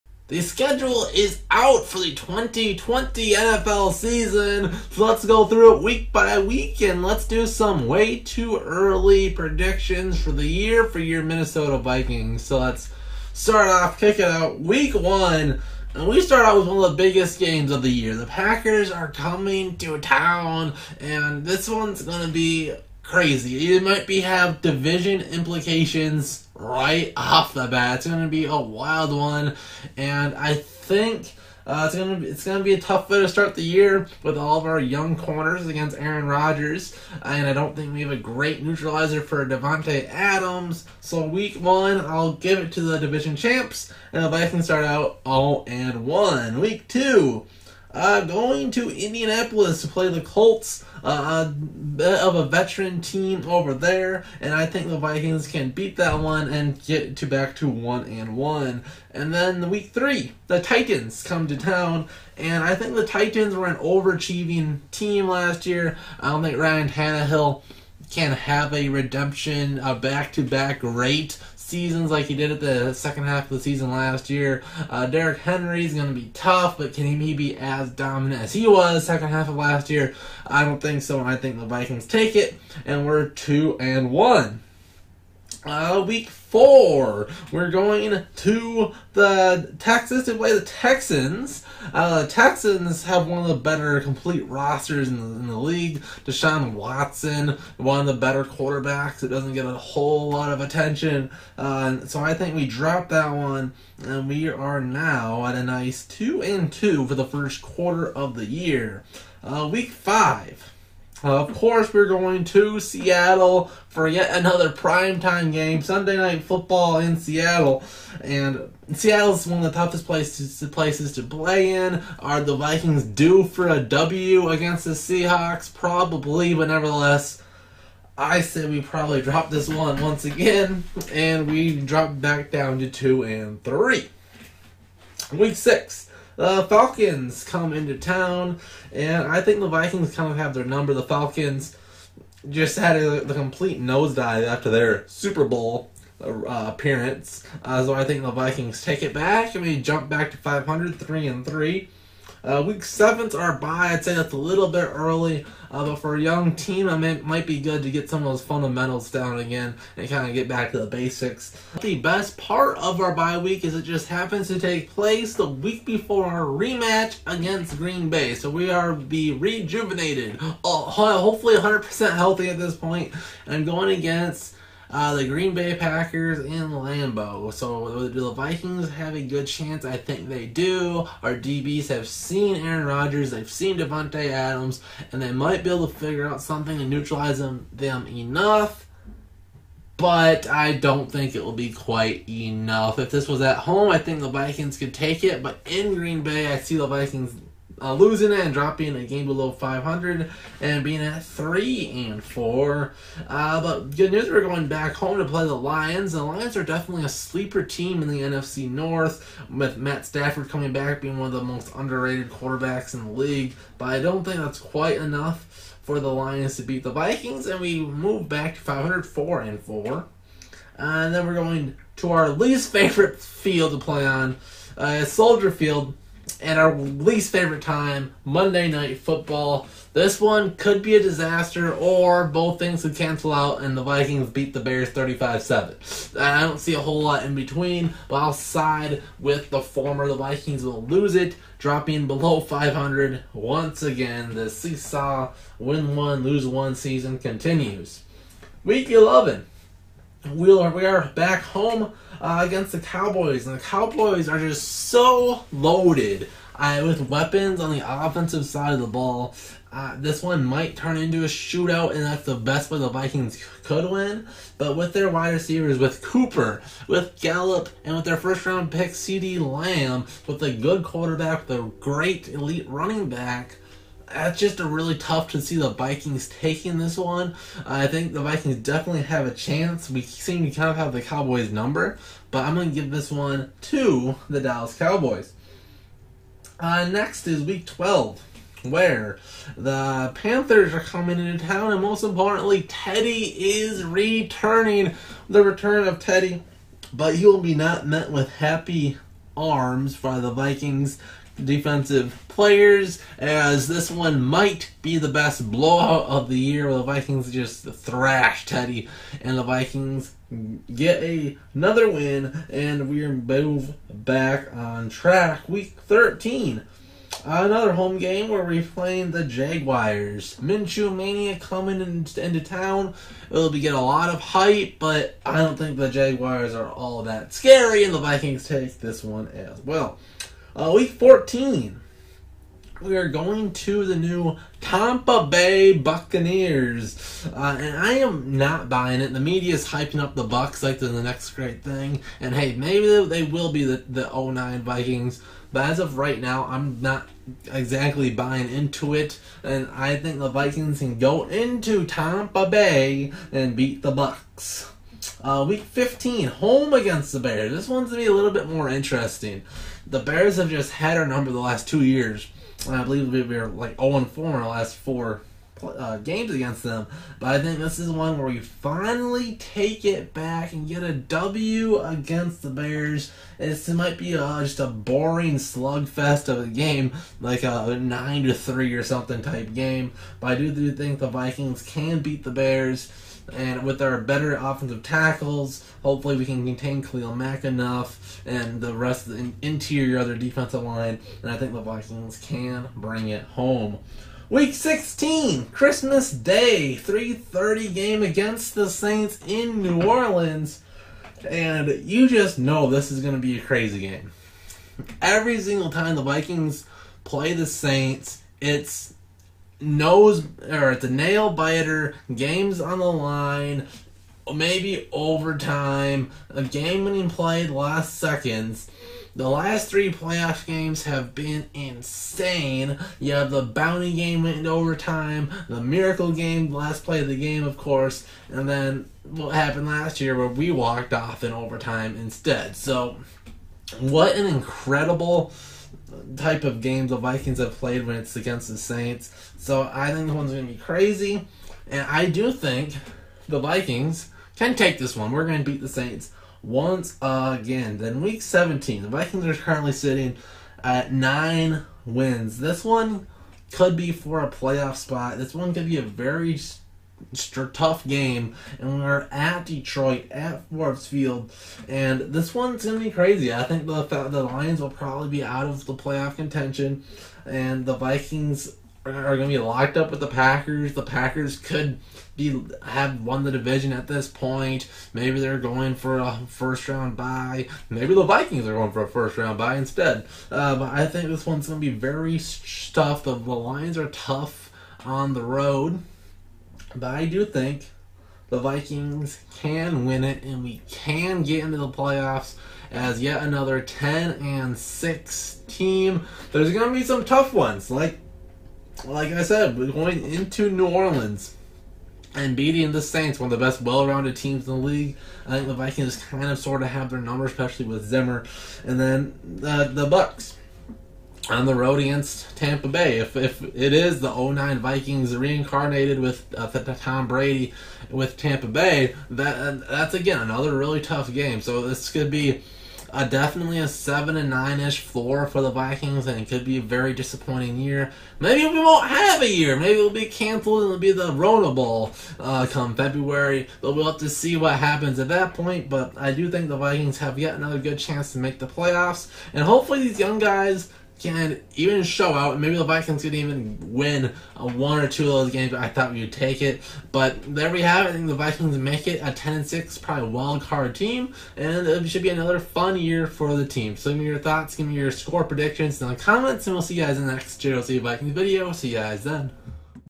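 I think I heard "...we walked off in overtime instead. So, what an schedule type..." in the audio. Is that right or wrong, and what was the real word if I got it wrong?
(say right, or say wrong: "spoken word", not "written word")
wrong: "incredible", not "schedule".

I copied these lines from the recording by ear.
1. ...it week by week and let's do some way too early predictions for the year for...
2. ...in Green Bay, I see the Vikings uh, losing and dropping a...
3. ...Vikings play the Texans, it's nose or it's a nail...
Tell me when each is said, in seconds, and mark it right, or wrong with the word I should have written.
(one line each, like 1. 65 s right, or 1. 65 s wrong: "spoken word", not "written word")
1. 5 s right
2. 195 s right
3. 406 s wrong: "Saints", not "Texans".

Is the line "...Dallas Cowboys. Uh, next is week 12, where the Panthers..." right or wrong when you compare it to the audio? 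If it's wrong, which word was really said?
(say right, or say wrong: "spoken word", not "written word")
right.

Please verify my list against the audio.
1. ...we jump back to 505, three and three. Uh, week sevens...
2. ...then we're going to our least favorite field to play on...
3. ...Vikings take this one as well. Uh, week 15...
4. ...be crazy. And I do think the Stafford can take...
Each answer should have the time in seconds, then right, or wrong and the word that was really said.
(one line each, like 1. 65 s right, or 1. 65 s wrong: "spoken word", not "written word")
1. 149 s wrong: "500", not "505"
2. 221 s right
3. 327 s wrong: "14", not "15"
4. 440 s wrong: "Vikings", not "Stafford".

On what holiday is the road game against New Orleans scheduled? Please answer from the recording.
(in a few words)
Christmas Day.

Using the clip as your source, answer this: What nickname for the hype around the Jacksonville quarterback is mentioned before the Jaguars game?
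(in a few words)
Minshew Mania.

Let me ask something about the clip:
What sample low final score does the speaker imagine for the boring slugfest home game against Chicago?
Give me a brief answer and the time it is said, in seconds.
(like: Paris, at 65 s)
9 to 3, at 377 s.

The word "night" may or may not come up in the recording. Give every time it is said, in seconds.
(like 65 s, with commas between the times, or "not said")
116 s, 228 s.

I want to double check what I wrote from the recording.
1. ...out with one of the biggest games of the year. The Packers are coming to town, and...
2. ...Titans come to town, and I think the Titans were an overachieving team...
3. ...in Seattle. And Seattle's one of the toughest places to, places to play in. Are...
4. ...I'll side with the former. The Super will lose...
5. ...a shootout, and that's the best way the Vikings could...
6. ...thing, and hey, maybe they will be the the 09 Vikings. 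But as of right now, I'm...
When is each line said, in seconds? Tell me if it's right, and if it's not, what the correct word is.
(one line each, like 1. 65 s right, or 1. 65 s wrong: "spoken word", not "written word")
1. 16 s right
2. 60 s right
3. 116 s right
4. 238 s wrong: "Vikings", not "Super"
5. 261 s right
6. 341 s right.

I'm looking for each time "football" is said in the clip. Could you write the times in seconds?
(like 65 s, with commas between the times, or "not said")
116 s, 228 s.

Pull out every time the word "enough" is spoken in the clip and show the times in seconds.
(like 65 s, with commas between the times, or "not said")
188 s, 192 s, 214 s, 387 s.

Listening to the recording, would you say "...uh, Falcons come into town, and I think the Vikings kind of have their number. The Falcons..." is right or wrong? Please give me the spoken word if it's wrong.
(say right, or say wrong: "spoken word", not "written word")
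right.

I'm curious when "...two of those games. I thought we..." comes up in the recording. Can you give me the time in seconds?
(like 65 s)
544 s.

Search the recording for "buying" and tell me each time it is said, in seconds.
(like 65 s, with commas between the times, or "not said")
338 s, 348 s.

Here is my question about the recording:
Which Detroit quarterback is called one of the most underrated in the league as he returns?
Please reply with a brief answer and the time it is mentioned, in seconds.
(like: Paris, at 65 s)
Matt Stafford, at 209 s.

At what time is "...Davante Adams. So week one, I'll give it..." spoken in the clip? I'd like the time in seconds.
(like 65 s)
39 s.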